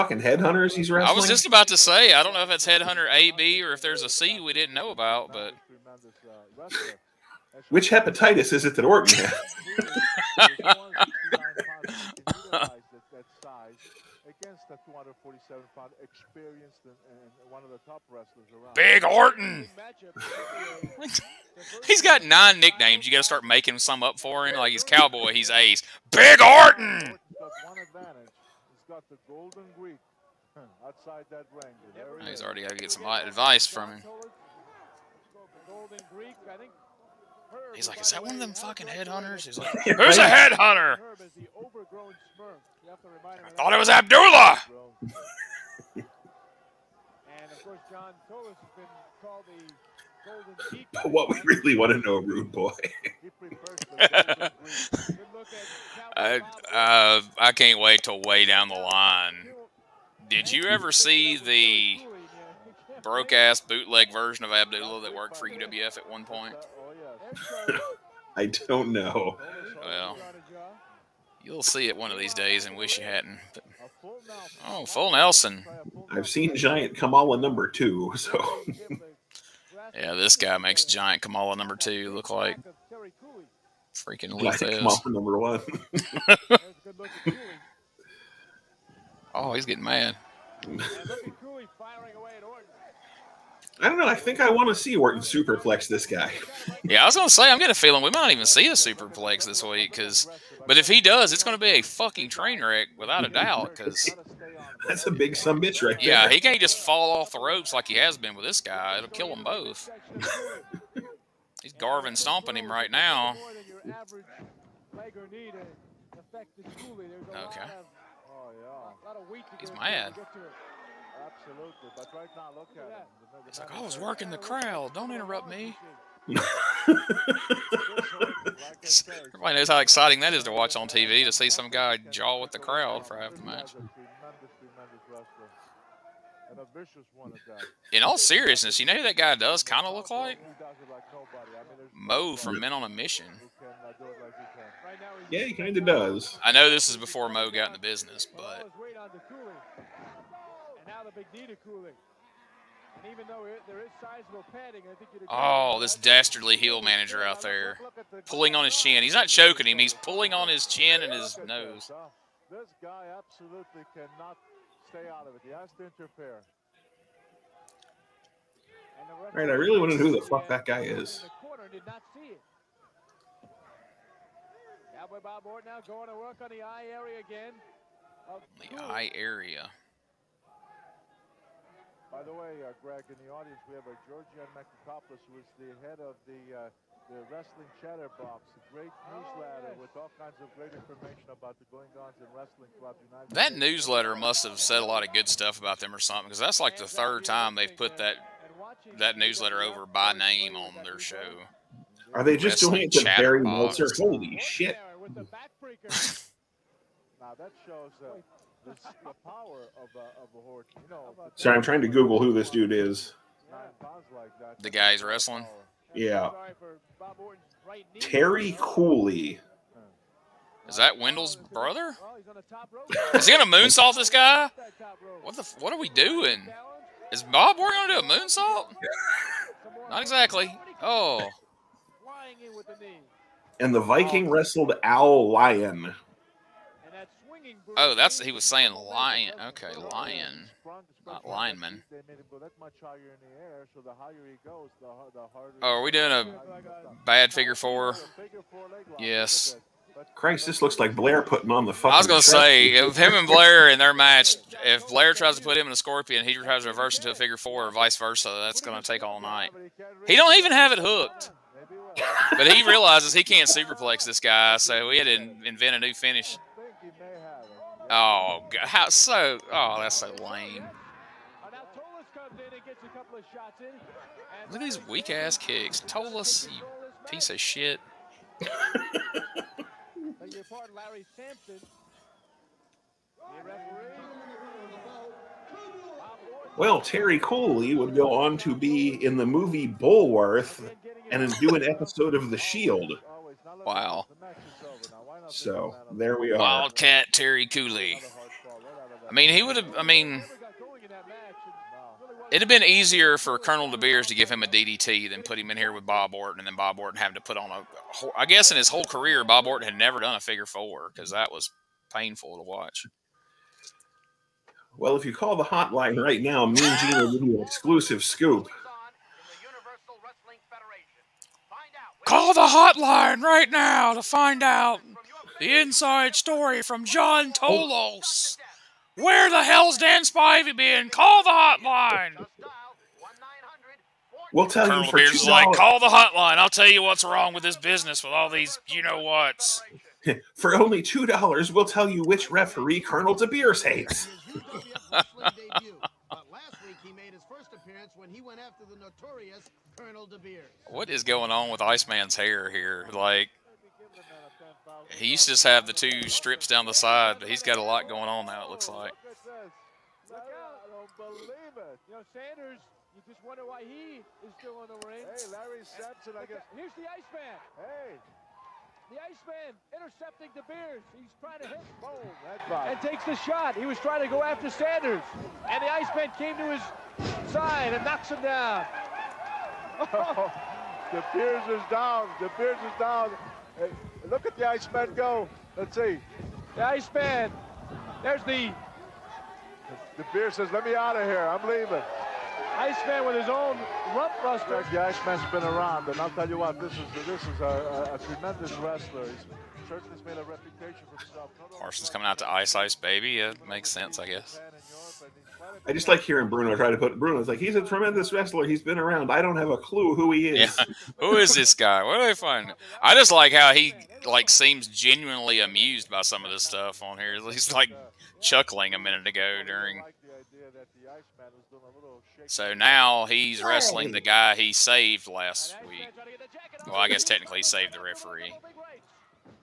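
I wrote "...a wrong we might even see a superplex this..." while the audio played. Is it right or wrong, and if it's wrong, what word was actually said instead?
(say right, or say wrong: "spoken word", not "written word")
wrong: "feeling", not "wrong".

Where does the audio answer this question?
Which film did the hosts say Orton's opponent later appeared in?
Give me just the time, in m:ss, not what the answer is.
4:49.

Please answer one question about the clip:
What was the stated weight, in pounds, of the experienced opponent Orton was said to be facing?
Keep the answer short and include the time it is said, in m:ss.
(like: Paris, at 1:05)
247, at 0:14.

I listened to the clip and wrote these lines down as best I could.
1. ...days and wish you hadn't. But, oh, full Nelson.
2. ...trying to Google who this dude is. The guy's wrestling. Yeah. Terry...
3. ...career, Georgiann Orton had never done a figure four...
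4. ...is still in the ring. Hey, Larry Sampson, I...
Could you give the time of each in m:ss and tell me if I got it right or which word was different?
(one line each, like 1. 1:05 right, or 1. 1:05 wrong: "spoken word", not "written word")
1. 1:12 right
2. 3:31 right
3. 5:08 wrong: "Bob", not "Georgiann"
4. 6:04 right.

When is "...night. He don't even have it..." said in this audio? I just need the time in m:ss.
4:19.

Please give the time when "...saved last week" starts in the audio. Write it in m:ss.
7:04.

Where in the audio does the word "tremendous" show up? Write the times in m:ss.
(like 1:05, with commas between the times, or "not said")
6:37, 6:47.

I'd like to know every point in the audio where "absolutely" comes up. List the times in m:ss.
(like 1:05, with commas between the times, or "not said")
2:01, 2:43.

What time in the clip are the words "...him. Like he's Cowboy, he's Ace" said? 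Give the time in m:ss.
0:24.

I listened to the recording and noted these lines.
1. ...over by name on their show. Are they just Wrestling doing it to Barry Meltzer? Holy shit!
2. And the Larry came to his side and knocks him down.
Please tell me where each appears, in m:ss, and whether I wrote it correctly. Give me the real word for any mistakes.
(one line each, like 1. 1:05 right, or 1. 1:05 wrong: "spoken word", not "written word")
1. 3:19 right
2. 6:15 wrong: "Iceman", not "Larry".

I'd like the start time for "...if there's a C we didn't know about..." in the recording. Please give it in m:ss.
0:03.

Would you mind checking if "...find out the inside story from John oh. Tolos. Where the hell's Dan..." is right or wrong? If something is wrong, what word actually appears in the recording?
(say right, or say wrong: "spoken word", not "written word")
right.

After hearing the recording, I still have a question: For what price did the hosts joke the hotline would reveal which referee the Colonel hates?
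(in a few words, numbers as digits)
$2.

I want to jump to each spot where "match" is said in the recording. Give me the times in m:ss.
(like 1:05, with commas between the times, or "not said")
2:13, 4:13.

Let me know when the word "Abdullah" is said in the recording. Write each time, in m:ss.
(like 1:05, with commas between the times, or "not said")
0:43, 1:04.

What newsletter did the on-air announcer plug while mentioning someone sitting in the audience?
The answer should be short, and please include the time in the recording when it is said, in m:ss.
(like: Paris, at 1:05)
The Wrestling Chatterbox, at 3:07.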